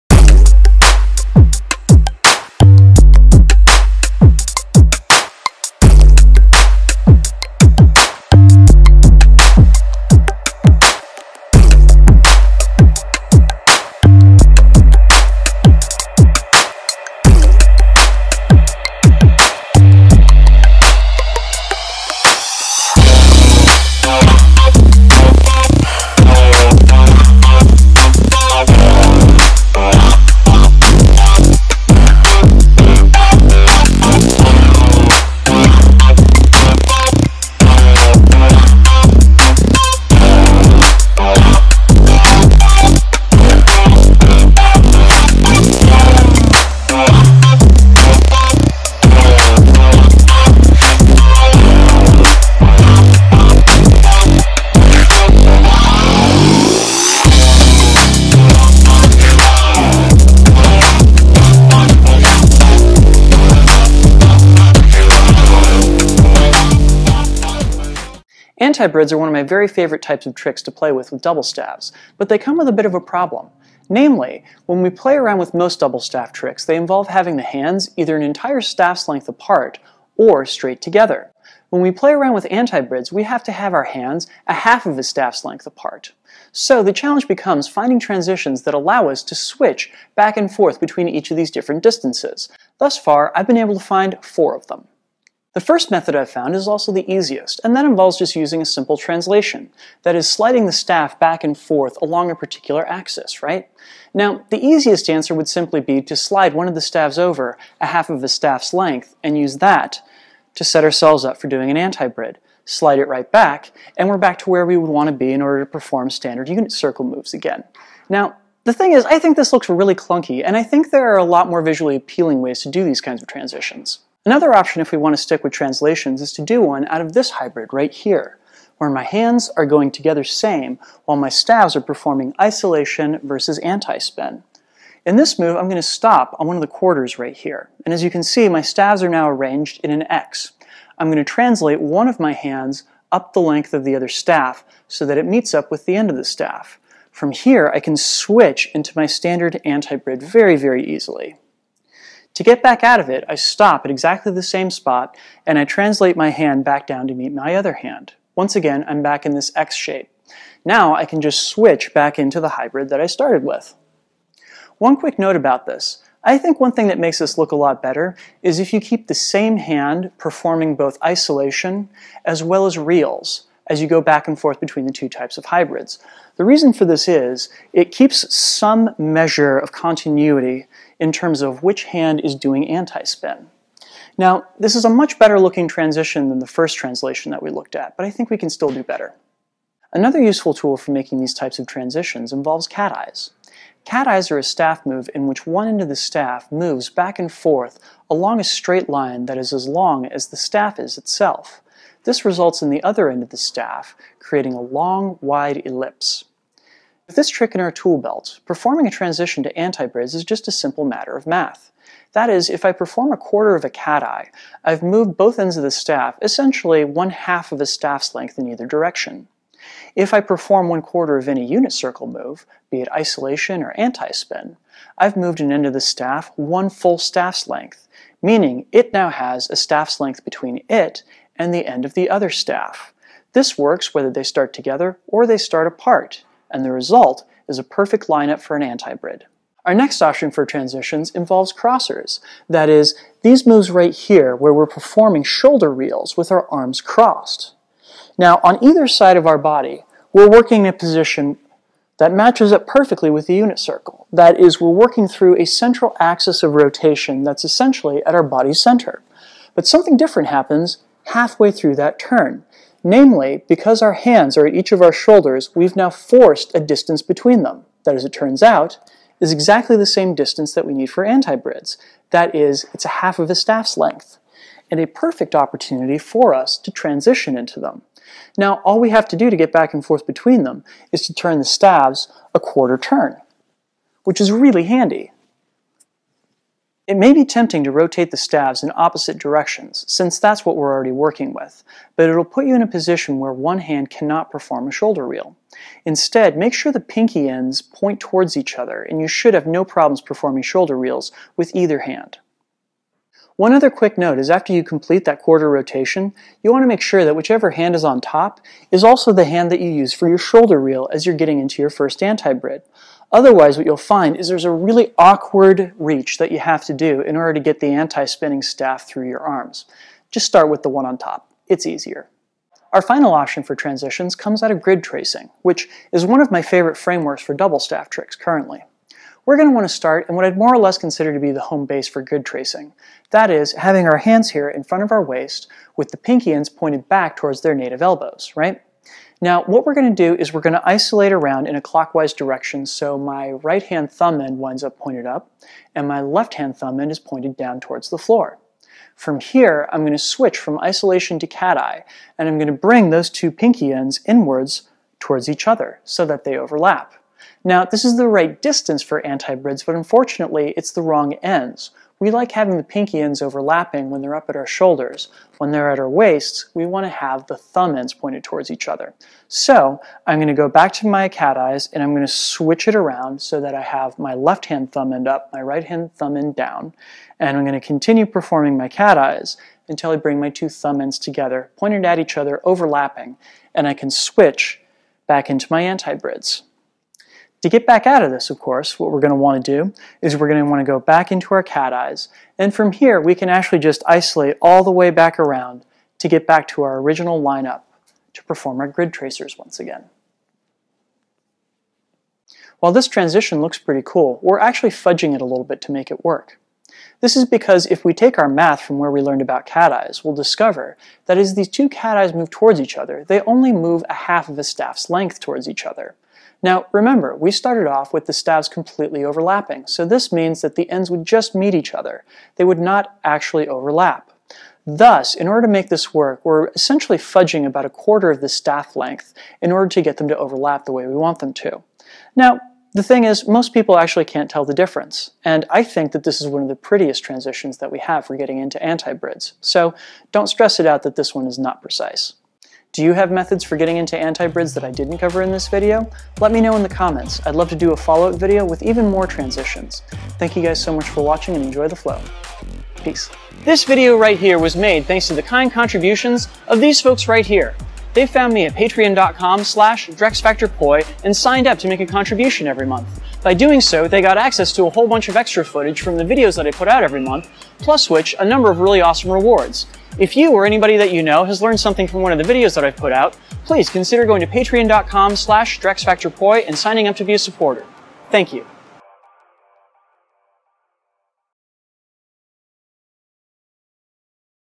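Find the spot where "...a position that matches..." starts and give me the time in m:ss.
4:10.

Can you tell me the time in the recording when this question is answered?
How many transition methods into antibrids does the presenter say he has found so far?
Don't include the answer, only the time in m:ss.
1:34.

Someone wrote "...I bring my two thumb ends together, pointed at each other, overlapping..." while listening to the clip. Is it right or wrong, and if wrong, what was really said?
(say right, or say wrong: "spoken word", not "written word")
right.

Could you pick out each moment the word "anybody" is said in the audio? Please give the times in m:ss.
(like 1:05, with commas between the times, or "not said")
7:50.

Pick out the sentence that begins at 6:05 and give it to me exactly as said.
When they're at our waists, we want to have the thumb ends pointed towards each other.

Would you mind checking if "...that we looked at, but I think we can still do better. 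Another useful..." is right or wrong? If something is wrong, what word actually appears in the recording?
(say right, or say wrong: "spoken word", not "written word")
right.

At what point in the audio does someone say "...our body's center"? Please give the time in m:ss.
4:18.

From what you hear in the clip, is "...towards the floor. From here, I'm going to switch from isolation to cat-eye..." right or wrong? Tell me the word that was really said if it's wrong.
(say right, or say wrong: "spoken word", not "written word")
right.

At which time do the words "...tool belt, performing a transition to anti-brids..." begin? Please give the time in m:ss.
3:27.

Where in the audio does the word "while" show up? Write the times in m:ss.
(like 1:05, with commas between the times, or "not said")
2:11, 6:42.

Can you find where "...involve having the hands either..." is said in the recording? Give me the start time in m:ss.
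1:16.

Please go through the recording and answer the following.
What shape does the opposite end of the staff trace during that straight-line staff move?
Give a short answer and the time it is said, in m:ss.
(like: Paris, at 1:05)
ellipse, at 3:24.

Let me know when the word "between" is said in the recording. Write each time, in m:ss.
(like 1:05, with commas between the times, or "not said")
1:30, 2:54, 3:50, 4:27, 4:40.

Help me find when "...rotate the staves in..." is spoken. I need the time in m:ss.
4:47.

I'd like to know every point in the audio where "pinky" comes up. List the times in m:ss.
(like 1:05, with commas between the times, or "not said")
4:56, 5:35, 5:53, 6:02.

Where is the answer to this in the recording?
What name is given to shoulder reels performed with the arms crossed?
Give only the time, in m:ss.
4:01.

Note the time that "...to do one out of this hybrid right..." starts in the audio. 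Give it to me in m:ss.
2:06.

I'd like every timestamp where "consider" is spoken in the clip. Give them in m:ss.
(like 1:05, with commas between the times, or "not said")
5:30, 7:53.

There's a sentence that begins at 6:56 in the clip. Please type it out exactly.
Now, remember, we started off with the staves completely overlapping, so this means that the ends would just meet each other.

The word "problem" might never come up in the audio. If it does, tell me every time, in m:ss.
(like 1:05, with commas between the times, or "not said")
1:13, 4:59.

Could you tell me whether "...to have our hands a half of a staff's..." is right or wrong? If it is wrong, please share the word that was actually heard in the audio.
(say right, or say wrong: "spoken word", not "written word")
right.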